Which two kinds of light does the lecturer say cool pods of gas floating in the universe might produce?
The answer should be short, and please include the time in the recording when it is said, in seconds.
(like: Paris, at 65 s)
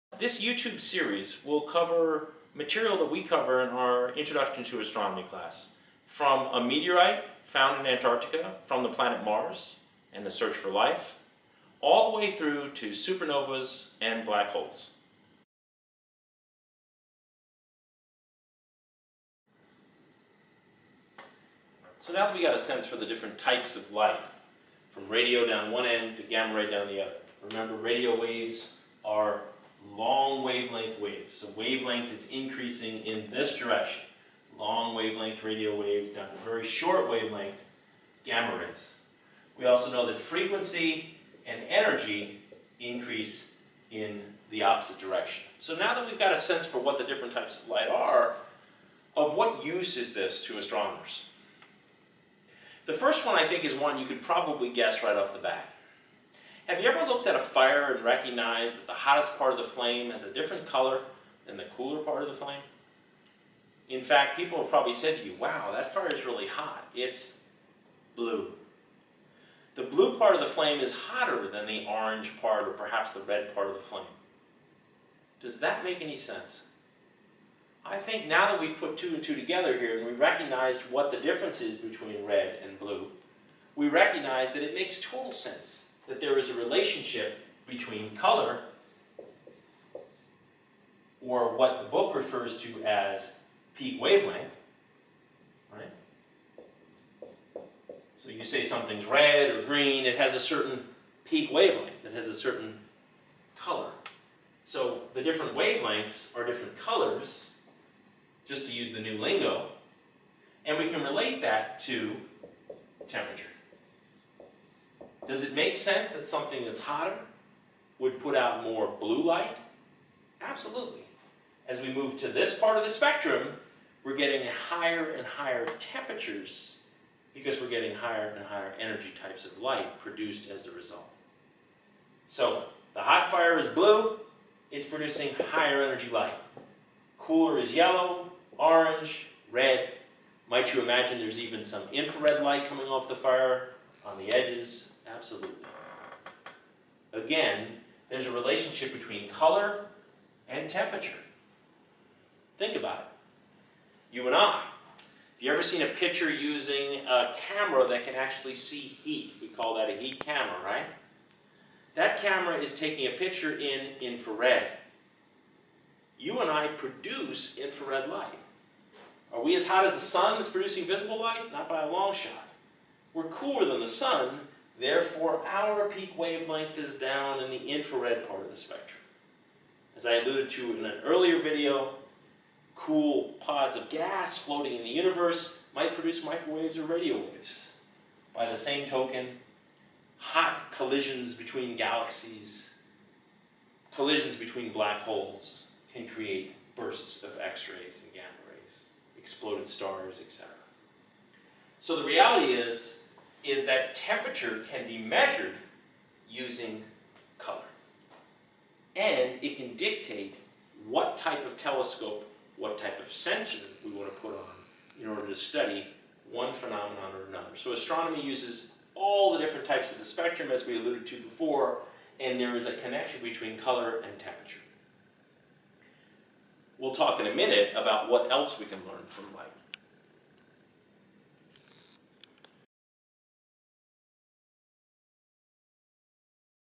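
microwaves or radio waves, at 186 s.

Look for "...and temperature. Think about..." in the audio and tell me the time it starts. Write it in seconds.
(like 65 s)
150 s.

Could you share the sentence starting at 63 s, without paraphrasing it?
In fact, people have probably said to you, wow, that fire is really hot.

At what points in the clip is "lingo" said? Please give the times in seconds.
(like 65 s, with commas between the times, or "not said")
109 s.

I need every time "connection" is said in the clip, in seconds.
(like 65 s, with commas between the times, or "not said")
222 s.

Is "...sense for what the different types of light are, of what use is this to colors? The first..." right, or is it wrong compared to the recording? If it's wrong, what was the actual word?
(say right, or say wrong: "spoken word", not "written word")
wrong: "astronomers", not "colors".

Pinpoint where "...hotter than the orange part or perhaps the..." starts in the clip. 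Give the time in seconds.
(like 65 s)
70 s.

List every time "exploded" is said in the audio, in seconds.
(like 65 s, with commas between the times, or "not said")
199 s.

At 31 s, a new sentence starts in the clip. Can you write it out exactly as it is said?
So wavelength is increasing in this direction.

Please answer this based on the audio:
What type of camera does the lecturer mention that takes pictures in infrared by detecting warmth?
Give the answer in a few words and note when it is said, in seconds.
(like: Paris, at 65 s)
heat camera, at 159 s.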